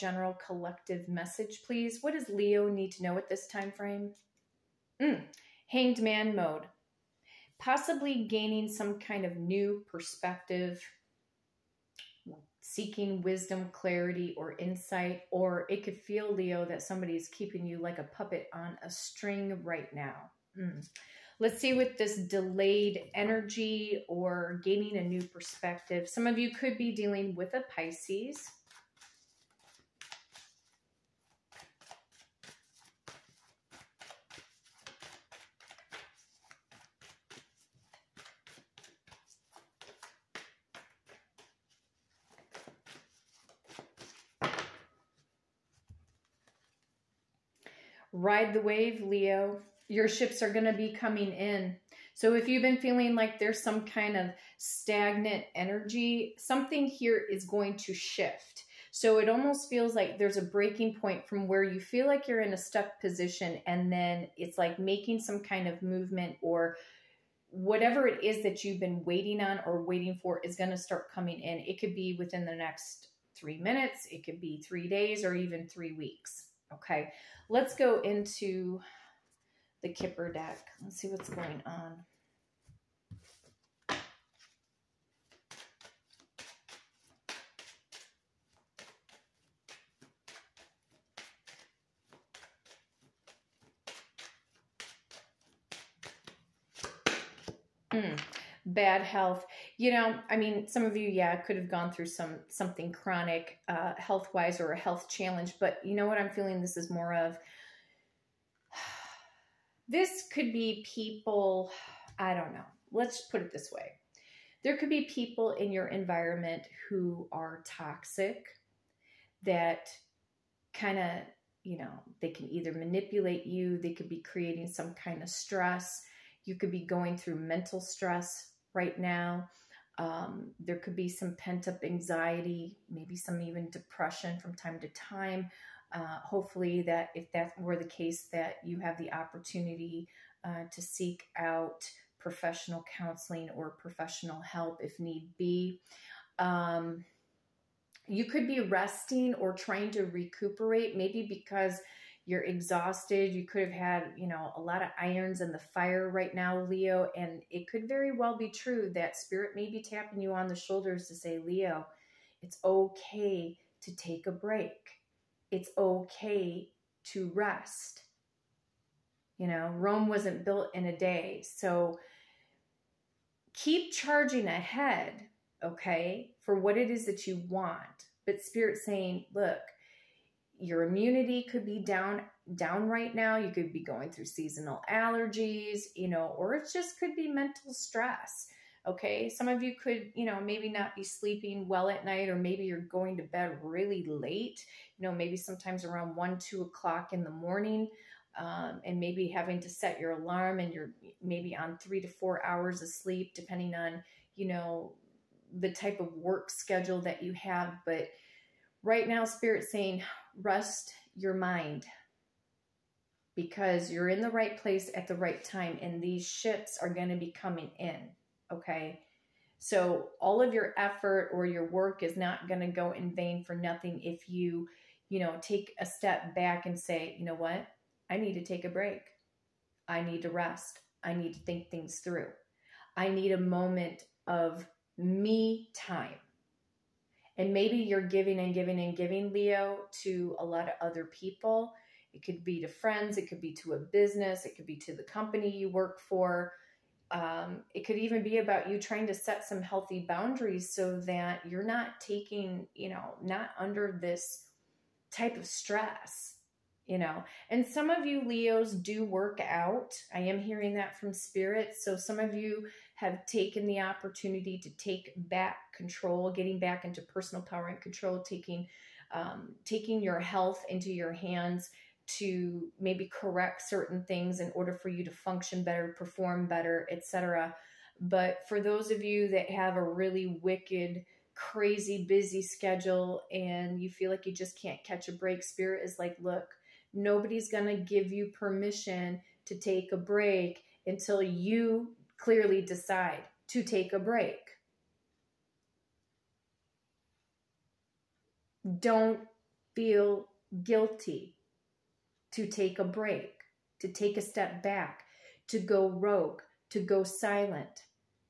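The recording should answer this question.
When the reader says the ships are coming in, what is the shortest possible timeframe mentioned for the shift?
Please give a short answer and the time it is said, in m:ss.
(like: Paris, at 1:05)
3 minutes, at 1:13.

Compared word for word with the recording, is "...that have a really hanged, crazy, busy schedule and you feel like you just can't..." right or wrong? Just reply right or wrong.
wrong.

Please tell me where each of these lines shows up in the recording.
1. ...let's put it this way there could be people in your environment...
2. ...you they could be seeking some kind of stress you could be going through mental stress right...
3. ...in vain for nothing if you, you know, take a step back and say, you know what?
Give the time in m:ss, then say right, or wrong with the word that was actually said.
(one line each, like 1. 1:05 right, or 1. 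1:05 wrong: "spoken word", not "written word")
1. 1:52 right
2. 2:03 wrong: "creating", not "seeking"
3. 3:42 right.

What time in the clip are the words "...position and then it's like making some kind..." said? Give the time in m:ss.
1:03.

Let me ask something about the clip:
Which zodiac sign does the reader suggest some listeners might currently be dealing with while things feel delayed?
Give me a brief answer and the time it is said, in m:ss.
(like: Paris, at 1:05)
Pisces, at 0:27.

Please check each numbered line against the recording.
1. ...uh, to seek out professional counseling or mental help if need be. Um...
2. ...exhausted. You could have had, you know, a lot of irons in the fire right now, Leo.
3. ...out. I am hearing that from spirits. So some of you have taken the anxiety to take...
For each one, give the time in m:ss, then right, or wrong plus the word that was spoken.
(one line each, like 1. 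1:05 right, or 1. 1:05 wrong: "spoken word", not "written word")
1. 2:20 wrong: "professional", not "mental"
2. 2:32 right
3. 4:19 wrong: "opportunity", not "anxiety".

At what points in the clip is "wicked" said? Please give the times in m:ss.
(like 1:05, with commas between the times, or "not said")
4:40.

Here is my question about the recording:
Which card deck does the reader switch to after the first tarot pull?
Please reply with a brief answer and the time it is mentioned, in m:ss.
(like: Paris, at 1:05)
Kipper deck, at 1:19.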